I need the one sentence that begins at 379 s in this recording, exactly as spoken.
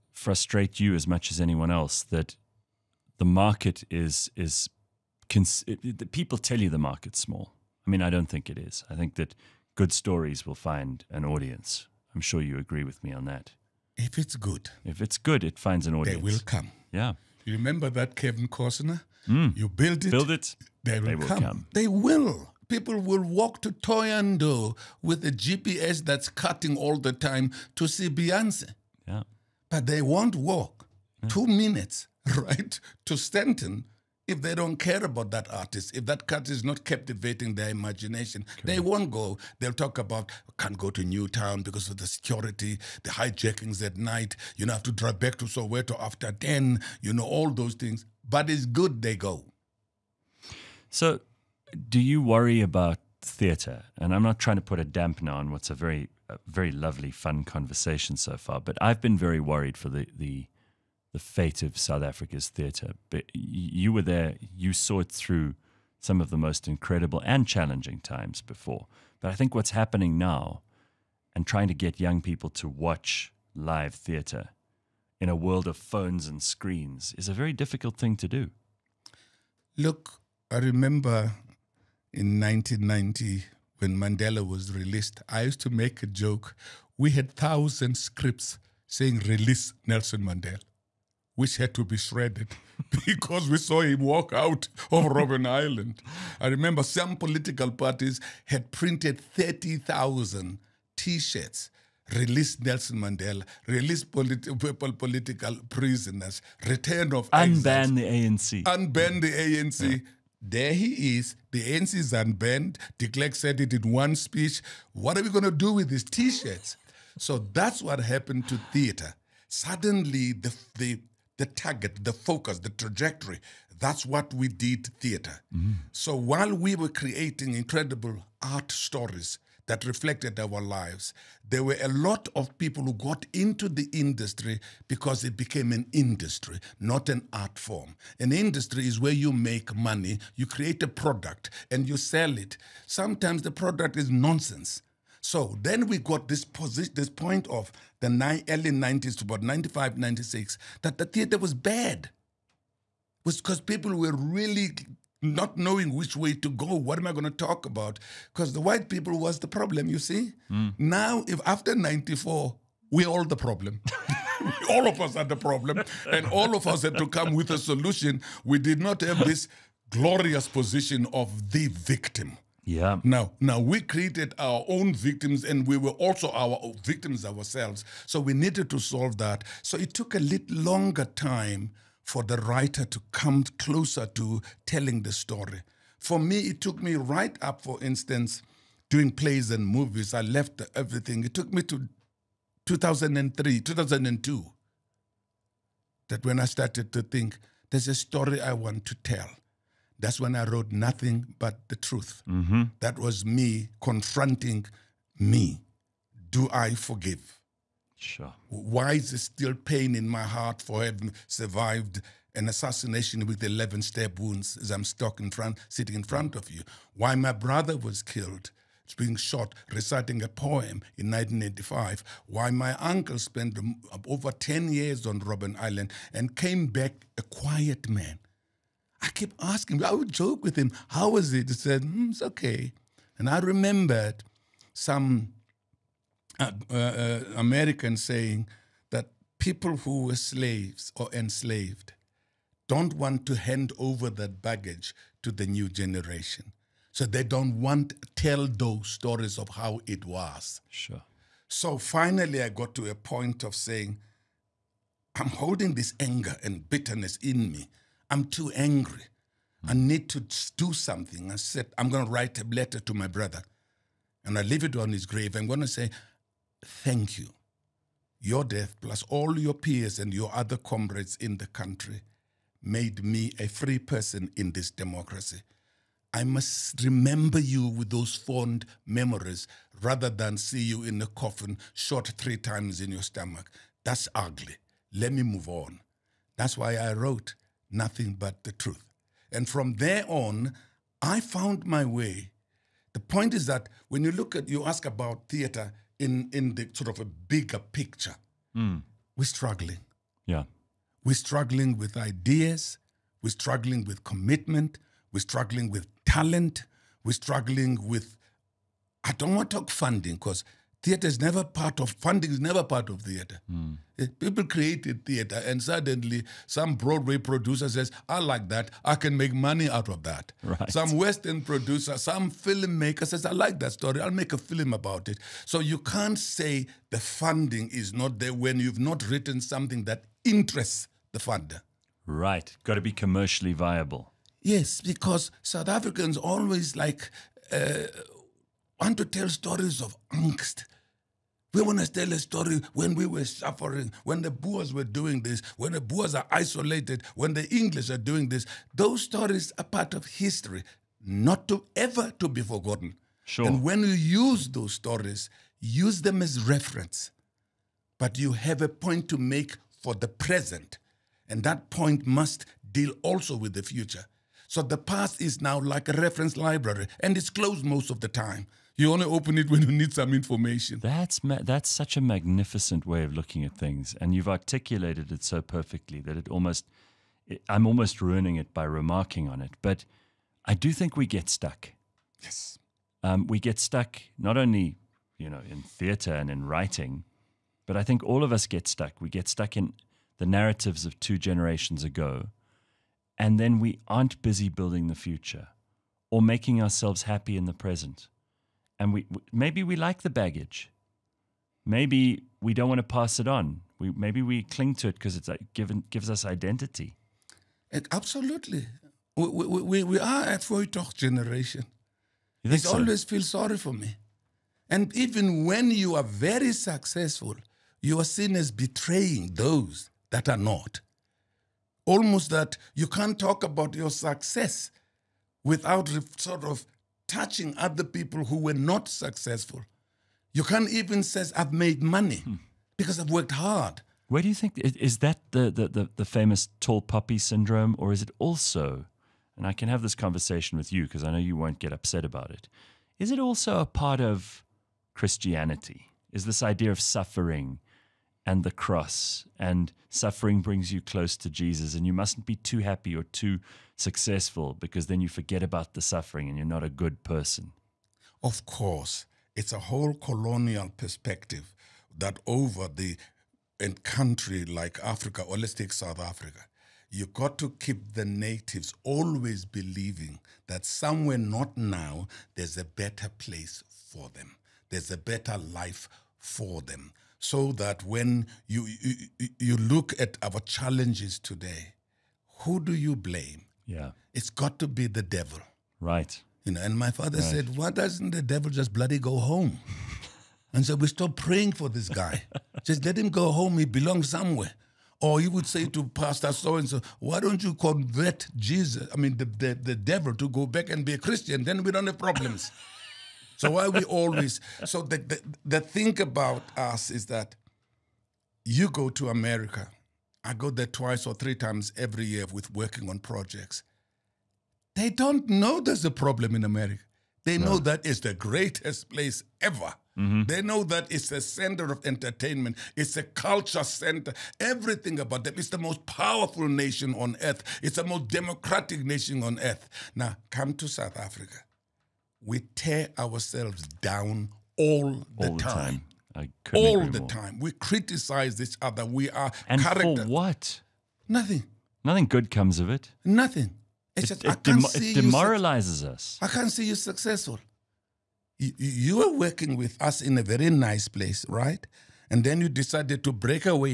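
But I do think we get stuck.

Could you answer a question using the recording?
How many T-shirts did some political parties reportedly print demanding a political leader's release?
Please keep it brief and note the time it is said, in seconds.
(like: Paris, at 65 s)
30,000, at 99 s.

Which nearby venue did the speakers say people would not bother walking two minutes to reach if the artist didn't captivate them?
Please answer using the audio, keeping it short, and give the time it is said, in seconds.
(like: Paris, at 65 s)
Stanton, at 33 s.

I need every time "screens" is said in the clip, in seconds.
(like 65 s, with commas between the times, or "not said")
76 s.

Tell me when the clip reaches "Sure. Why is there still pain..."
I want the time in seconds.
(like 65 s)
207 s.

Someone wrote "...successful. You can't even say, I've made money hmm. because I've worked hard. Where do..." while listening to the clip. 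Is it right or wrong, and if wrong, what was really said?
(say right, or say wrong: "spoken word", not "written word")
right.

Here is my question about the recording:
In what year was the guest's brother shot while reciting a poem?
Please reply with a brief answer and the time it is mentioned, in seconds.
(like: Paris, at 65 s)
1985, at 221 s.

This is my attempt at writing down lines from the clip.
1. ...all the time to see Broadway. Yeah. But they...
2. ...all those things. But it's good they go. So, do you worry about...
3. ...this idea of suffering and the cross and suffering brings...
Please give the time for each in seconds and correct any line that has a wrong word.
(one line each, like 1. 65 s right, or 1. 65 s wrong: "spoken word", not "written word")
1. 26 s wrong: "Beyonce", not "Broadway"
2. 47 s right
3. 446 s right.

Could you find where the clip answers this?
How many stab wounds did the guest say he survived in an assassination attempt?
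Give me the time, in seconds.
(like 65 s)
213 s.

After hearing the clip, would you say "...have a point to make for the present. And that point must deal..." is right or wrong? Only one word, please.
right.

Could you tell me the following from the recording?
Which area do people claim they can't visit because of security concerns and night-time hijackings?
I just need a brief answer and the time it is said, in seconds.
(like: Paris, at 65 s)
Newtown, at 41 s.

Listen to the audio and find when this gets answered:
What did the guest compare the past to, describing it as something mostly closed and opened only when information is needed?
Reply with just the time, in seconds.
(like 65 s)
365 s.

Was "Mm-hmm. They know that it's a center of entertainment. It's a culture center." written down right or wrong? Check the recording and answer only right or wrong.
right.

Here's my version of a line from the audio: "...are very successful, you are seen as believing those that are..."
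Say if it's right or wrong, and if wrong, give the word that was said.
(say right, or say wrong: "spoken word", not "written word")
wrong: "betraying", not "believing".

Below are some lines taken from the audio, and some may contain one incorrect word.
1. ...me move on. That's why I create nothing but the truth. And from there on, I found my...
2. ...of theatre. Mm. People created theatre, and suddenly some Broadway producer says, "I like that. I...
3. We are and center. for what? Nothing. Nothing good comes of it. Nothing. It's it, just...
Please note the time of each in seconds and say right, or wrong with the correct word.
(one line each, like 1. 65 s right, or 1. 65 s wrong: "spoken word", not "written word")
1. 285 s wrong: "wrote", not "create"
2. 312 s right
3. 538 s wrong: "character", not "center".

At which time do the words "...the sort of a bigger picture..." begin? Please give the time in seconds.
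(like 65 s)
296 s.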